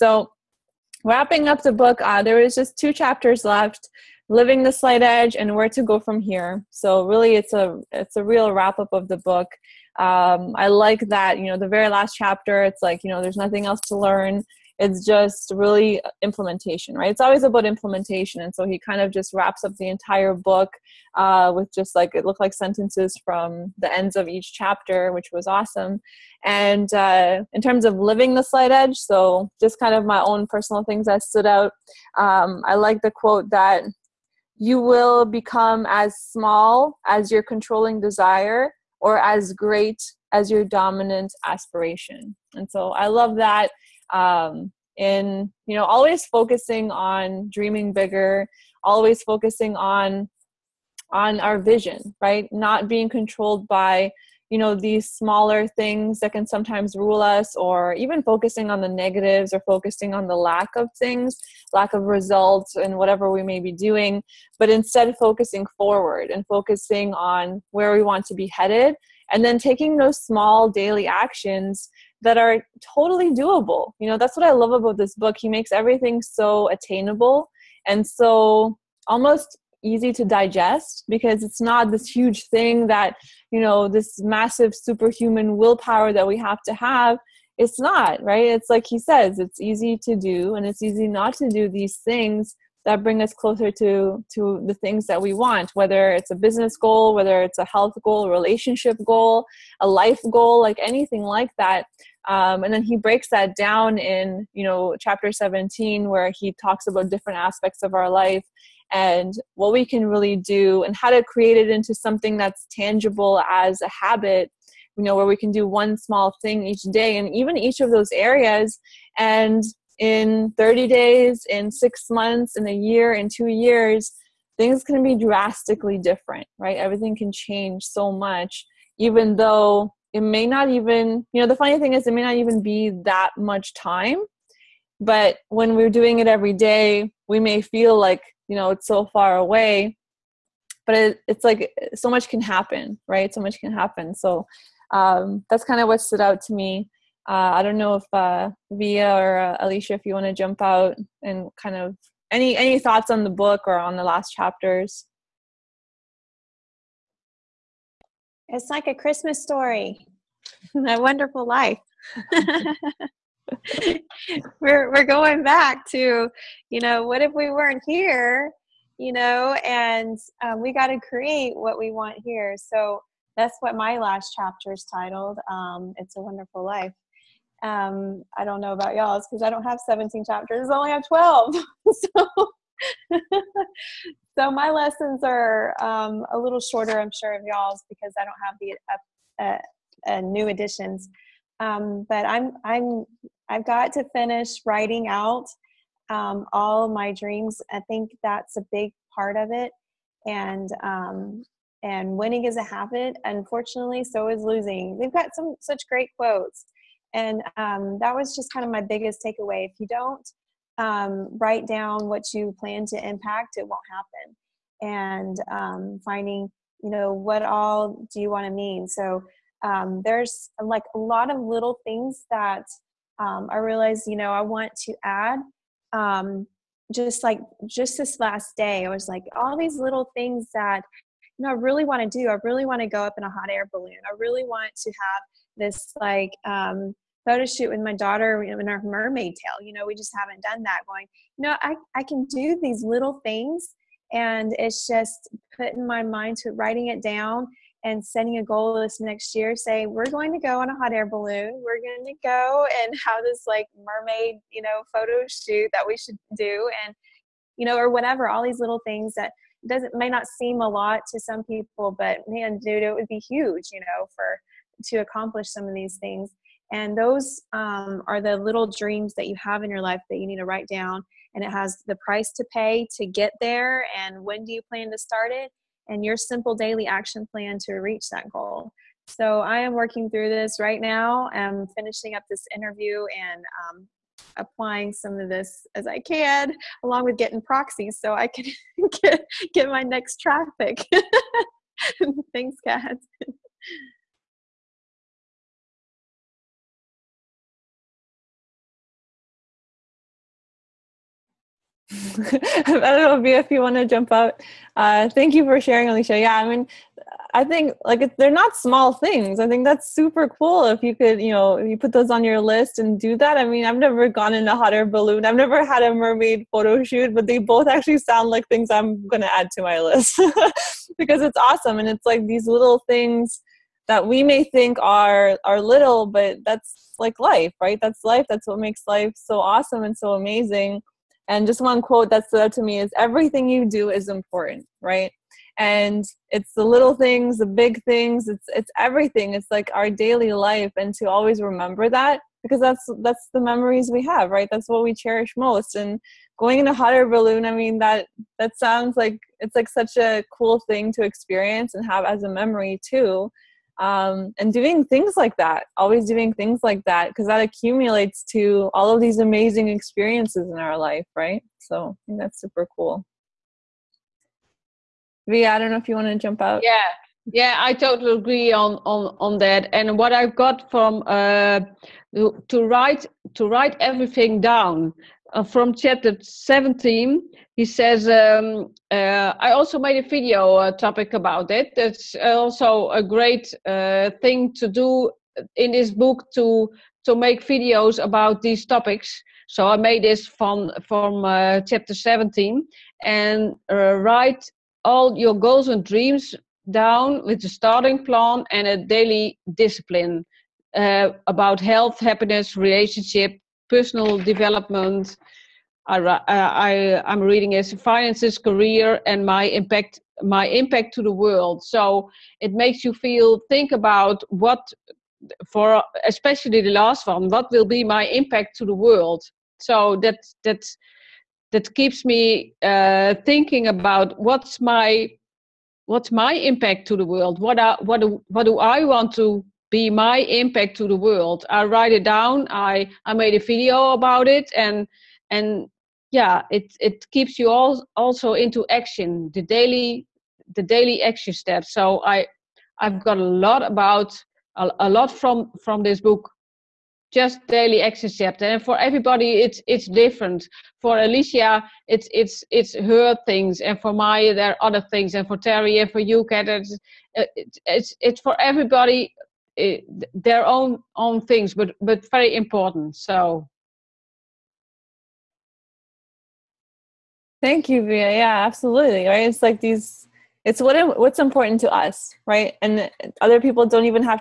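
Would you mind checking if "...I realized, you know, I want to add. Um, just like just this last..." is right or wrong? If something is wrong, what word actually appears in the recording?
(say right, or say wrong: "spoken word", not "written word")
right.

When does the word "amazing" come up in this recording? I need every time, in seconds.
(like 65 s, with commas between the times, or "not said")
330 s, 359 s.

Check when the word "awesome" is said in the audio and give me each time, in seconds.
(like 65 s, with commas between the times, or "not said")
25 s, 321 s, 329 s.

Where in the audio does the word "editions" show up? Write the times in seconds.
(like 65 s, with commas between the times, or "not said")
190 s.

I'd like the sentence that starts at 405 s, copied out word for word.
I, uh, I I'm reading as finances, career, and my impact my impact to the world.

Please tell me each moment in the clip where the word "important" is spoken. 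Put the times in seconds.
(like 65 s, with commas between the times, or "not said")
334 s, 462 s, 471 s.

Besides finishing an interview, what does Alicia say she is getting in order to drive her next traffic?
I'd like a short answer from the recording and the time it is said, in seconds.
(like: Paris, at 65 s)
Proxies, at 287 s.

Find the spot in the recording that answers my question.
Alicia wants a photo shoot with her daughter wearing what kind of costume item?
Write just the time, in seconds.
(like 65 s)
238 s.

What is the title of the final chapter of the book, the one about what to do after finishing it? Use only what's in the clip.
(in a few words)
Where to Go from Here.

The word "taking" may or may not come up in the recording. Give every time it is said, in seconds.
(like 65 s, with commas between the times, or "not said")
69 s.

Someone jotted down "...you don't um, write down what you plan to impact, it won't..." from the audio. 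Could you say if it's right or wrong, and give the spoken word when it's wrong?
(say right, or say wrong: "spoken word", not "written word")
right.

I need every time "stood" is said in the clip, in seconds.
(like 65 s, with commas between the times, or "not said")
31 s, 145 s, 332 s.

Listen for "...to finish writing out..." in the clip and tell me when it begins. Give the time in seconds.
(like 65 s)
193 s.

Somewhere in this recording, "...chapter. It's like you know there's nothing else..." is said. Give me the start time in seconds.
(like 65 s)
12 s.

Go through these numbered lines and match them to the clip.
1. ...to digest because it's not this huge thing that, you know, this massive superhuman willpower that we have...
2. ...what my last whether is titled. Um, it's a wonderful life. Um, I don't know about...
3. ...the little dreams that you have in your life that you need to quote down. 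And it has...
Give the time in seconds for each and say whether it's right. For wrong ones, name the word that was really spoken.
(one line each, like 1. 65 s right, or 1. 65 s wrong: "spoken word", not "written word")
1. 80 s right
2. 173 s wrong: "chapter", not "whether"
3. 268 s wrong: "write", not "quote".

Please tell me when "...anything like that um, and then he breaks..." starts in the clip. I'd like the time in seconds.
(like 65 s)
100 s.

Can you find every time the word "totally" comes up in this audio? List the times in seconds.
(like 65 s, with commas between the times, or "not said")
72 s, 367 s.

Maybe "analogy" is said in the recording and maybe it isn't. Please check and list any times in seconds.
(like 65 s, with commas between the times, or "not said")
not said.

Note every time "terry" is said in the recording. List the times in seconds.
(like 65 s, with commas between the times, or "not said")
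455 s.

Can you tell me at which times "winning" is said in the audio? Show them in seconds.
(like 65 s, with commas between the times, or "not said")
202 s.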